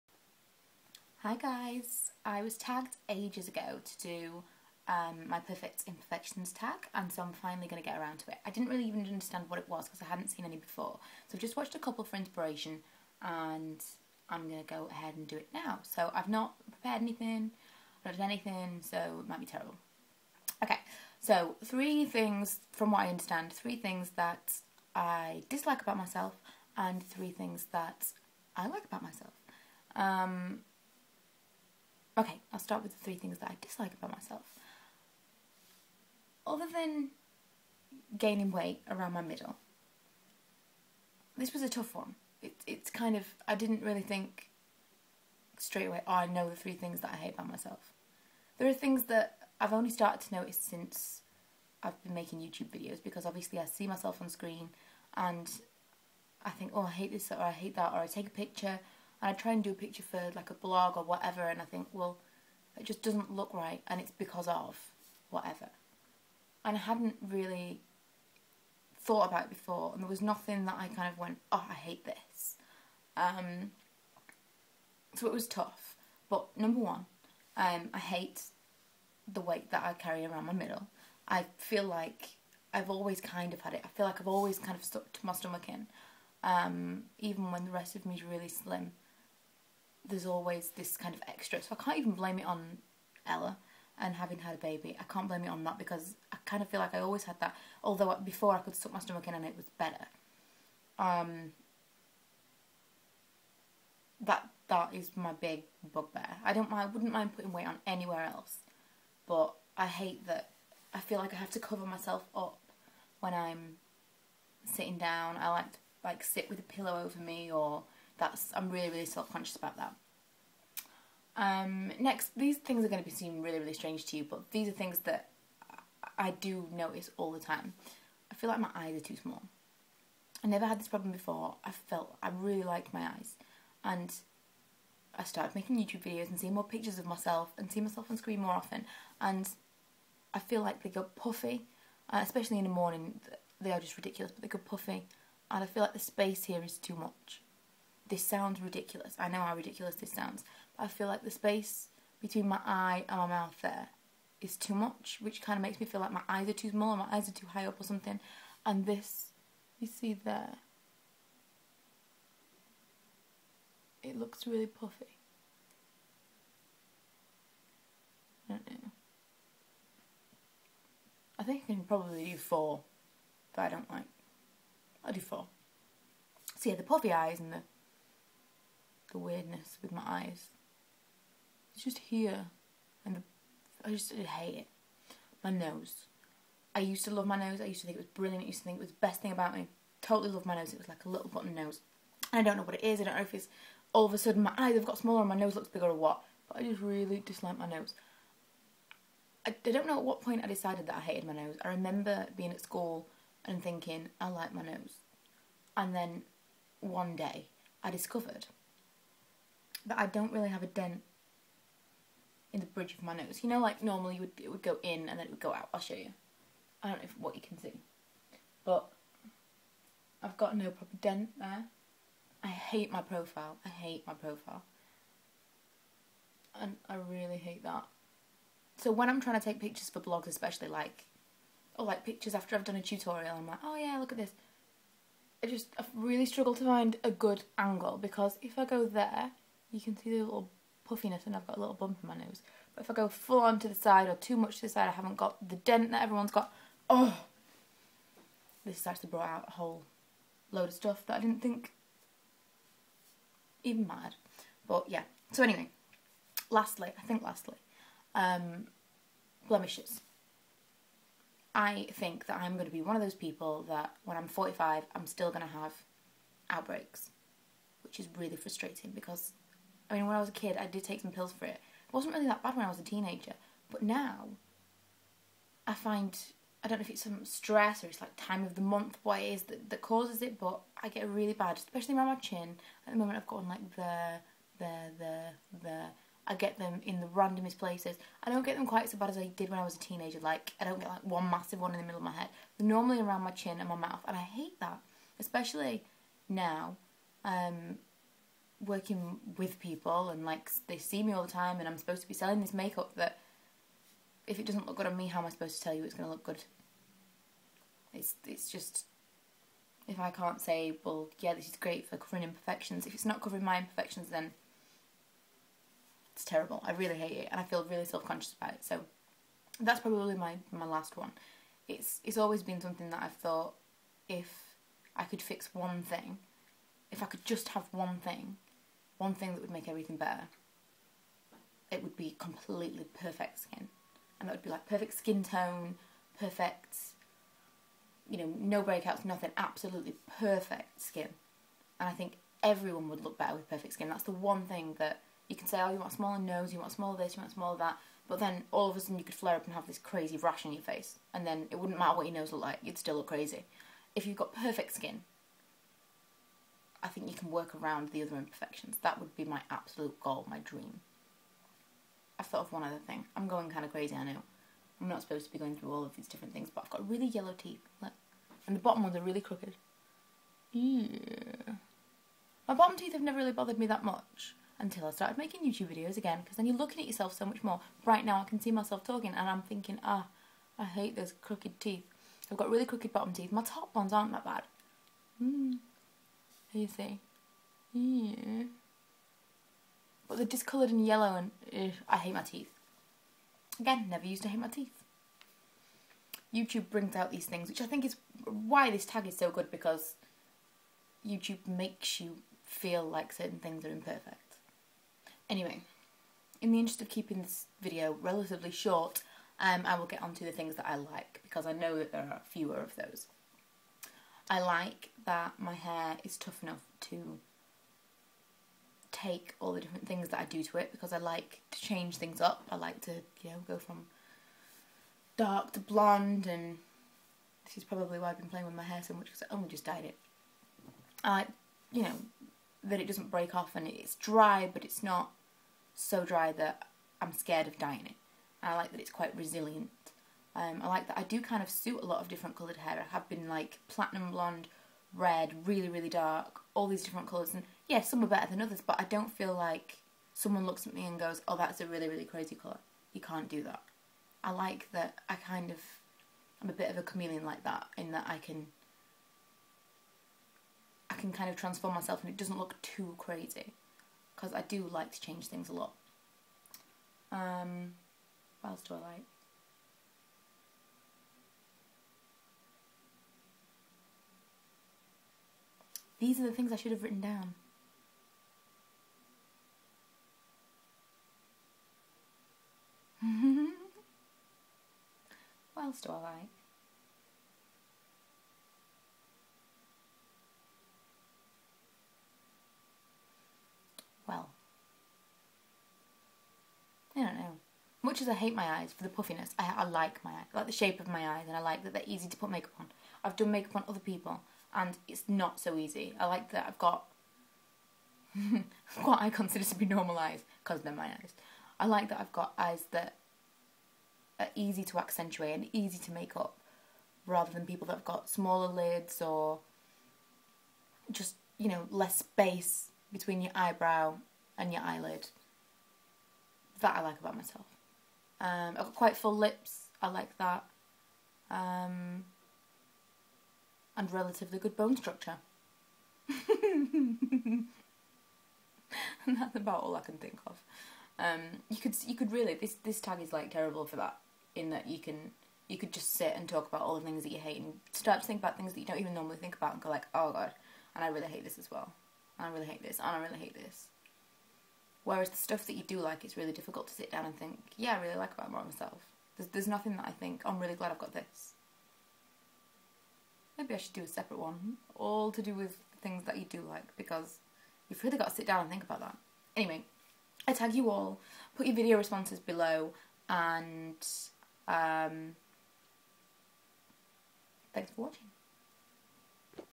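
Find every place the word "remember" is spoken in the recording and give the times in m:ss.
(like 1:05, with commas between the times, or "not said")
3:21.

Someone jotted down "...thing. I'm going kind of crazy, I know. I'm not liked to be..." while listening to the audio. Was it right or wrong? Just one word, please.
wrong.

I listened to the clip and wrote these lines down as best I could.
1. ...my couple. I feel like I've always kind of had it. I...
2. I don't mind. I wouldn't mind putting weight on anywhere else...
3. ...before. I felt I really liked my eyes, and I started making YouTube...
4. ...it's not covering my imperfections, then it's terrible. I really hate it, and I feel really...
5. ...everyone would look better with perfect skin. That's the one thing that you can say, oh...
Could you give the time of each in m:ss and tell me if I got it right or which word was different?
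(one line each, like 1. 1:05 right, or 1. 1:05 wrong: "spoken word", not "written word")
1. 1:20 wrong: "middle", not "couple"
2. 1:46 right
3. 2:11 right
4. 5:12 right
5. 5:42 right.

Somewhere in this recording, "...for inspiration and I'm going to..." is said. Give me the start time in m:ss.
0:12.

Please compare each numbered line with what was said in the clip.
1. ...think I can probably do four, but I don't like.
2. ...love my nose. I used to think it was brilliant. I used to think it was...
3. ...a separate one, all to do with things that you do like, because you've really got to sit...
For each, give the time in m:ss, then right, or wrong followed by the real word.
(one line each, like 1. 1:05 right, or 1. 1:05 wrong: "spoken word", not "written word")
1. 2:51 right
2. 3:07 right
3. 9:23 right.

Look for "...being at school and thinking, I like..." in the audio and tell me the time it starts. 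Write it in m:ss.
3:22.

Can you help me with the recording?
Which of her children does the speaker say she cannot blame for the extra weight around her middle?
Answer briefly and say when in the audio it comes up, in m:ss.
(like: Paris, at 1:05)
Ella, at 1:33.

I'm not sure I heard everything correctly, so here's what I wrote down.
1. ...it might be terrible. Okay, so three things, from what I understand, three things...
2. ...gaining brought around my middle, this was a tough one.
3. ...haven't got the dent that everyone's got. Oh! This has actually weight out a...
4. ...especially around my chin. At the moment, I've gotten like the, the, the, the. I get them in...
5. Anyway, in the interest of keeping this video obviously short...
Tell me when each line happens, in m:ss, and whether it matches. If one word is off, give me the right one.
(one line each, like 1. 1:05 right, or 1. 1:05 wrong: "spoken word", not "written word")
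1. 0:19 right
2. 0:38 wrong: "weight", not "brought"
3. 4:04 wrong: "brought", not "weight"
4. 4:41 right
5. 6:45 wrong: "relatively", not "obviously".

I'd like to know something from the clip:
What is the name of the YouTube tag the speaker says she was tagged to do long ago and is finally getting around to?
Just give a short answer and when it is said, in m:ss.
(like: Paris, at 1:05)
Perfect Imperfections, at 0:05.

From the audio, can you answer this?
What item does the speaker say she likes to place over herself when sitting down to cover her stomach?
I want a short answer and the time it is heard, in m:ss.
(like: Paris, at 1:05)
pillow, at 1:56.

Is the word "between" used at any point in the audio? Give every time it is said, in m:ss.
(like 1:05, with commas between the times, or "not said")
2:32, 8:42.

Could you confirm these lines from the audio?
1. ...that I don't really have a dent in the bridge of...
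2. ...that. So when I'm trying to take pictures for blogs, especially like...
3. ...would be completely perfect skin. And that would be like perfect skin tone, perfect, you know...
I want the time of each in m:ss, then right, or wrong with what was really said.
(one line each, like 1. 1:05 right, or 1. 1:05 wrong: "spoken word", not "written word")
1. 3:29 right
2. 3:47 right
3. 5:31 right.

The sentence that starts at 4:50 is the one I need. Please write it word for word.
Like, I don't get like one massive one in the middle of my head.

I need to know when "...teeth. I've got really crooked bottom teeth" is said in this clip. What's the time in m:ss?
6:21.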